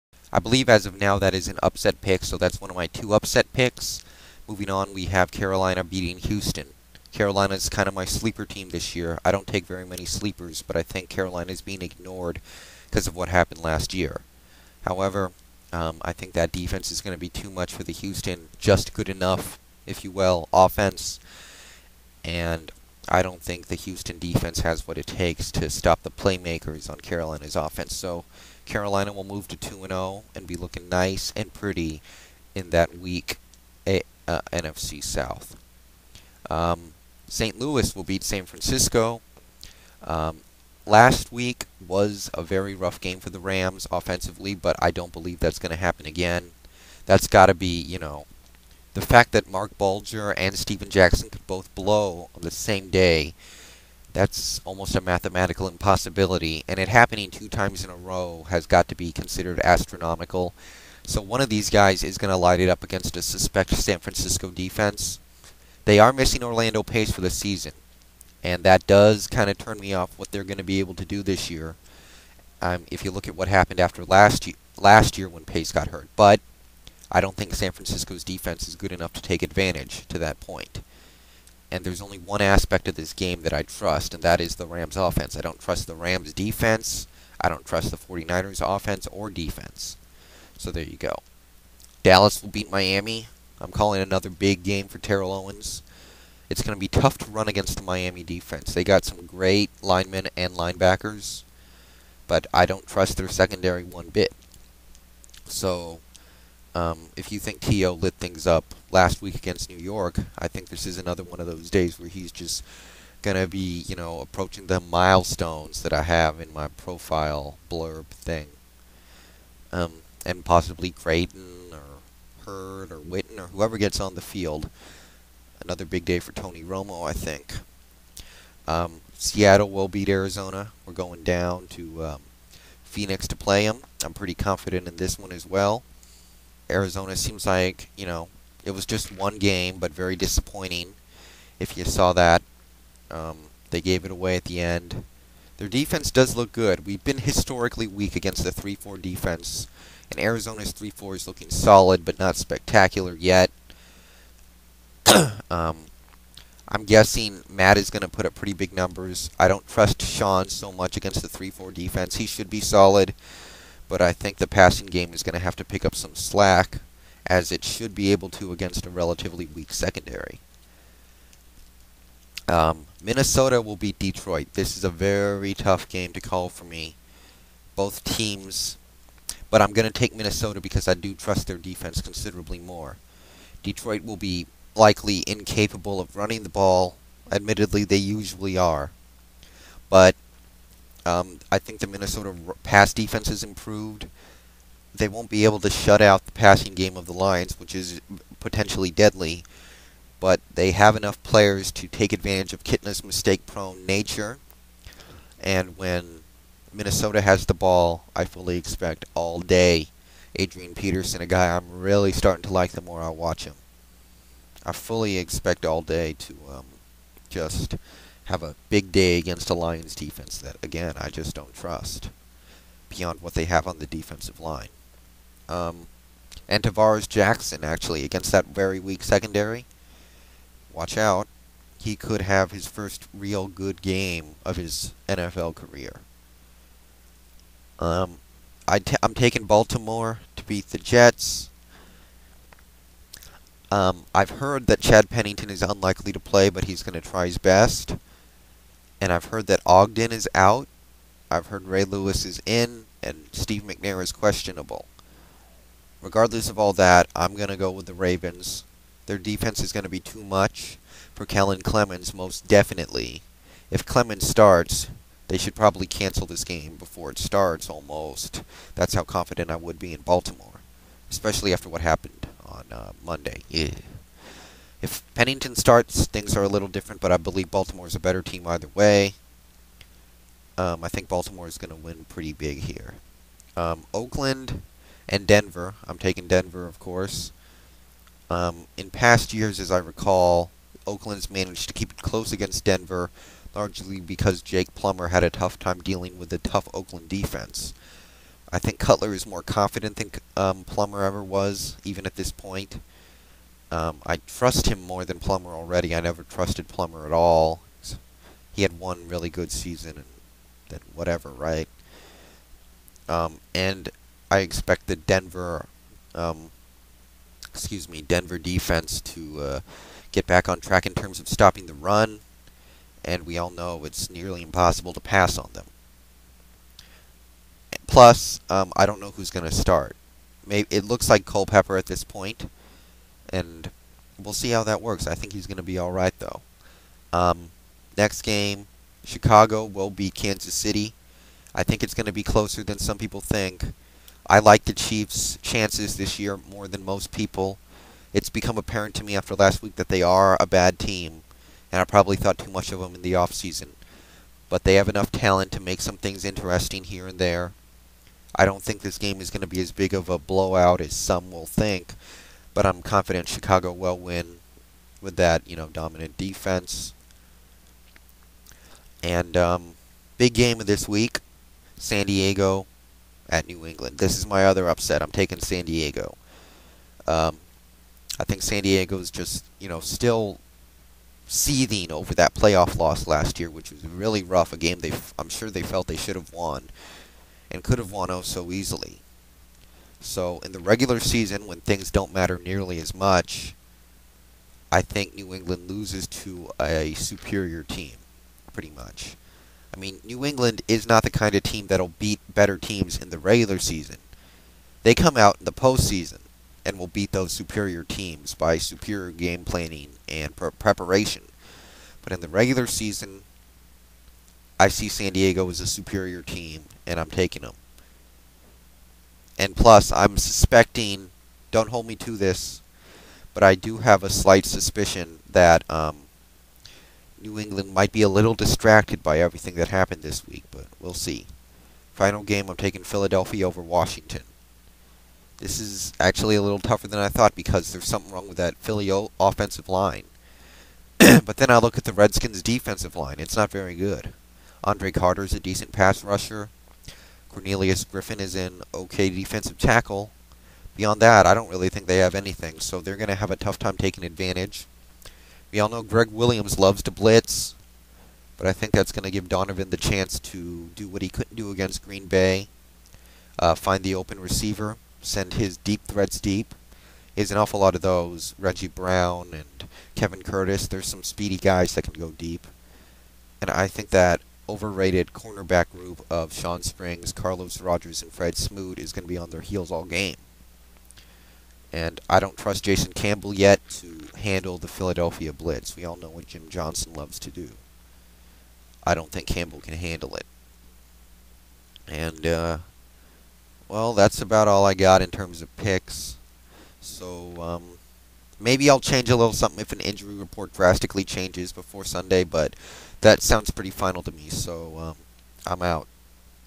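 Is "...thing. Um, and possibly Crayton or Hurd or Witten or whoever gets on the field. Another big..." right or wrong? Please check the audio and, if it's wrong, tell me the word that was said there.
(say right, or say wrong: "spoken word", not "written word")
right.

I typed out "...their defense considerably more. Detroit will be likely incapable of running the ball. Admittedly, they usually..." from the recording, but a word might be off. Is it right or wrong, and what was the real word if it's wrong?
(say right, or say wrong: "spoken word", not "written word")
right.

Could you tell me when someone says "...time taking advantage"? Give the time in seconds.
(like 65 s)
453 s.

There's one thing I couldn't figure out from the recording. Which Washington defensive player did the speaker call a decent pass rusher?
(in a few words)
Andre Carter.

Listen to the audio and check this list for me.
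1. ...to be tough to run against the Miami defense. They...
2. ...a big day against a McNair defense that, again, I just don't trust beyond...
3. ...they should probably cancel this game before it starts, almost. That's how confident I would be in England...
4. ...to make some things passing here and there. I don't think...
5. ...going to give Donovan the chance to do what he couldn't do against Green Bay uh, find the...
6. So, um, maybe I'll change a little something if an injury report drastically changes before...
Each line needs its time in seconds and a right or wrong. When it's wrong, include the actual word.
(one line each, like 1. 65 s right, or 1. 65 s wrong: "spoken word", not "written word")
1. 96 s right
2. 218 s wrong: "Lions", not "McNair"
3. 265 s wrong: "Baltimore", not "England"
4. 355 s wrong: "interesting", not "passing"
5. 458 s right
6. 496 s right.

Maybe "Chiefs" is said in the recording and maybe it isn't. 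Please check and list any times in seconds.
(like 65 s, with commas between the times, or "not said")
344 s.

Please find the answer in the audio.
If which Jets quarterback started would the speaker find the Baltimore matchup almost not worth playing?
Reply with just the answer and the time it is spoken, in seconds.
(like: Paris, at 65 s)
Kellen Clemens, at 261 s.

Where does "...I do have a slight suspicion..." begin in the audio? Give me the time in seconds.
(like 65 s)
423 s.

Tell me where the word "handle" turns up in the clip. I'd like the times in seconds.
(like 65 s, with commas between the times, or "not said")
484 s, 489 s.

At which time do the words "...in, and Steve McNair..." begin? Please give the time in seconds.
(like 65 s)
252 s.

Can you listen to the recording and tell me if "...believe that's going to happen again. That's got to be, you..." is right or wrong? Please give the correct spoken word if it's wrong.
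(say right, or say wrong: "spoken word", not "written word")
right.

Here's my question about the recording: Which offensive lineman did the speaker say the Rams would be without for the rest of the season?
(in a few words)
Orlando Pace.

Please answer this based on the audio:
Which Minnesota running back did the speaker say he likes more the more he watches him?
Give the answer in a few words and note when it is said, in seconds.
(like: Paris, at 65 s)
Adrian Peterson, at 210 s.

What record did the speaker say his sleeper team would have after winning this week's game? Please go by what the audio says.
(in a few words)
2 and 0.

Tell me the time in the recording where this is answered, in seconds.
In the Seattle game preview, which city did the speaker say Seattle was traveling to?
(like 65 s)
132 s.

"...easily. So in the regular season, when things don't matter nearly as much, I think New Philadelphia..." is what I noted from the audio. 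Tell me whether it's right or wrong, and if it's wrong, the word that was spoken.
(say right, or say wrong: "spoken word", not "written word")
wrong: "England", not "Philadelphia".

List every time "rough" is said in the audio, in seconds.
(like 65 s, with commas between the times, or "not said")
42 s, 384 s.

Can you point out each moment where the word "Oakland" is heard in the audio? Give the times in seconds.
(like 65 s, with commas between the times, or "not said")
283 s, 290 s, 296 s.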